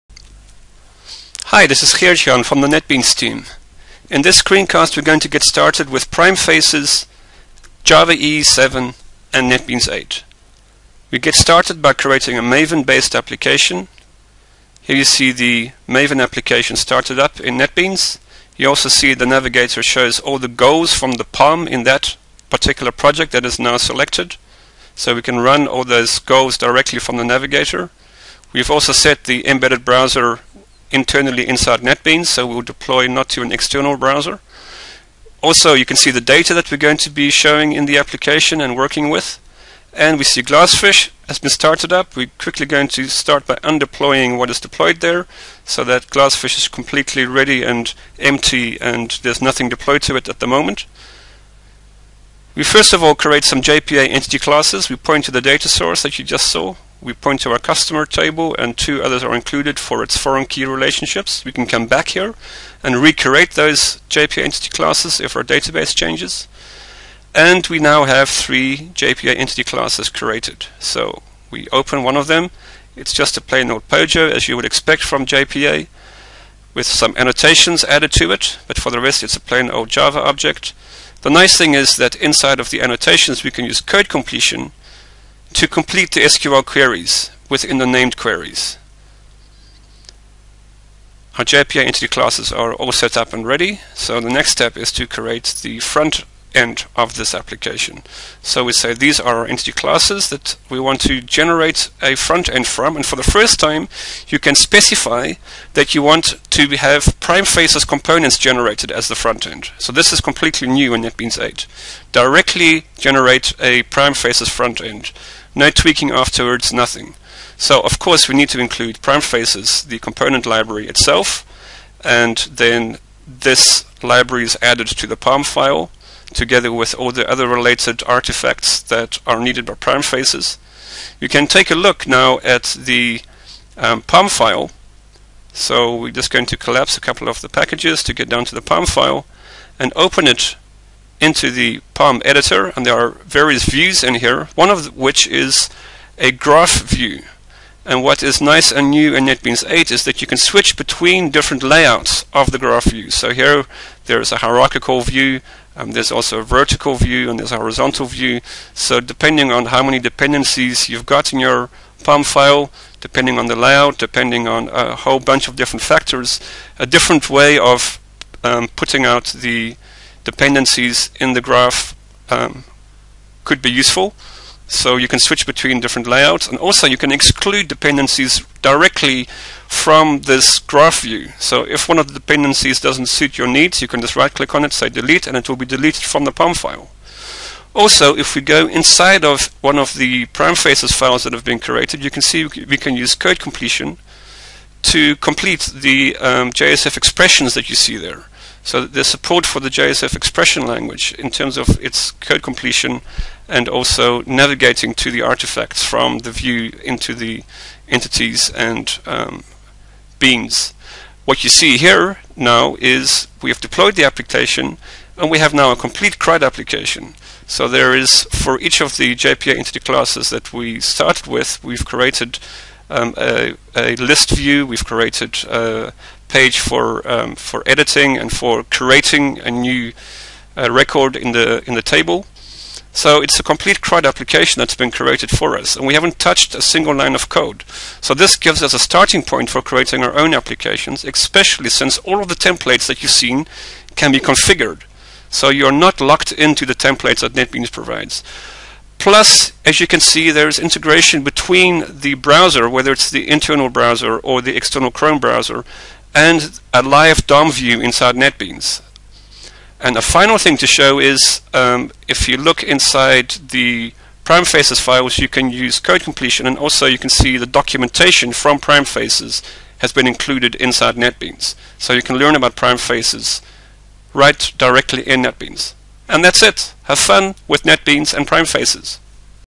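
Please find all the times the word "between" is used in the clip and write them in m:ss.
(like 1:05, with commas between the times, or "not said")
2:30, 2:55, 4:11.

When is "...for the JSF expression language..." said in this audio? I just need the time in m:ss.
3:19.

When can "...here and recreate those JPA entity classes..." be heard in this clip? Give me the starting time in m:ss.
1:02.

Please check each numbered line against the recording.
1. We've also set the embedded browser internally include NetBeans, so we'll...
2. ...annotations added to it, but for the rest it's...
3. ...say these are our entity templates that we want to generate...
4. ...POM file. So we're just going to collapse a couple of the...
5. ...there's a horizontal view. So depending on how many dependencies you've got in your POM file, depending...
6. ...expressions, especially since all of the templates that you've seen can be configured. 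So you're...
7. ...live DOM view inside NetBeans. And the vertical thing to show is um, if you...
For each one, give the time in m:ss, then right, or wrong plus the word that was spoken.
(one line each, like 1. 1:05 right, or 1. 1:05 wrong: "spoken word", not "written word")
1. 0:28 wrong: "inside", not "include"
2. 1:17 right
3. 1:38 wrong: "classes", not "templates"
4. 2:14 right
5. 2:37 right
6. 4:00 wrong: "applications", not "expressions"
7. 4:16 wrong: "final", not "vertical".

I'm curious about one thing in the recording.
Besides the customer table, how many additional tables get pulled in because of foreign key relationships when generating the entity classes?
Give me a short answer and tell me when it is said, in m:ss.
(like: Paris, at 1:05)
2, at 0:58.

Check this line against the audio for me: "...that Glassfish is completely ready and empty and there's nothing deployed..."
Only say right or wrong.
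right.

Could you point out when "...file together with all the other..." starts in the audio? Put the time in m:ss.
2:05.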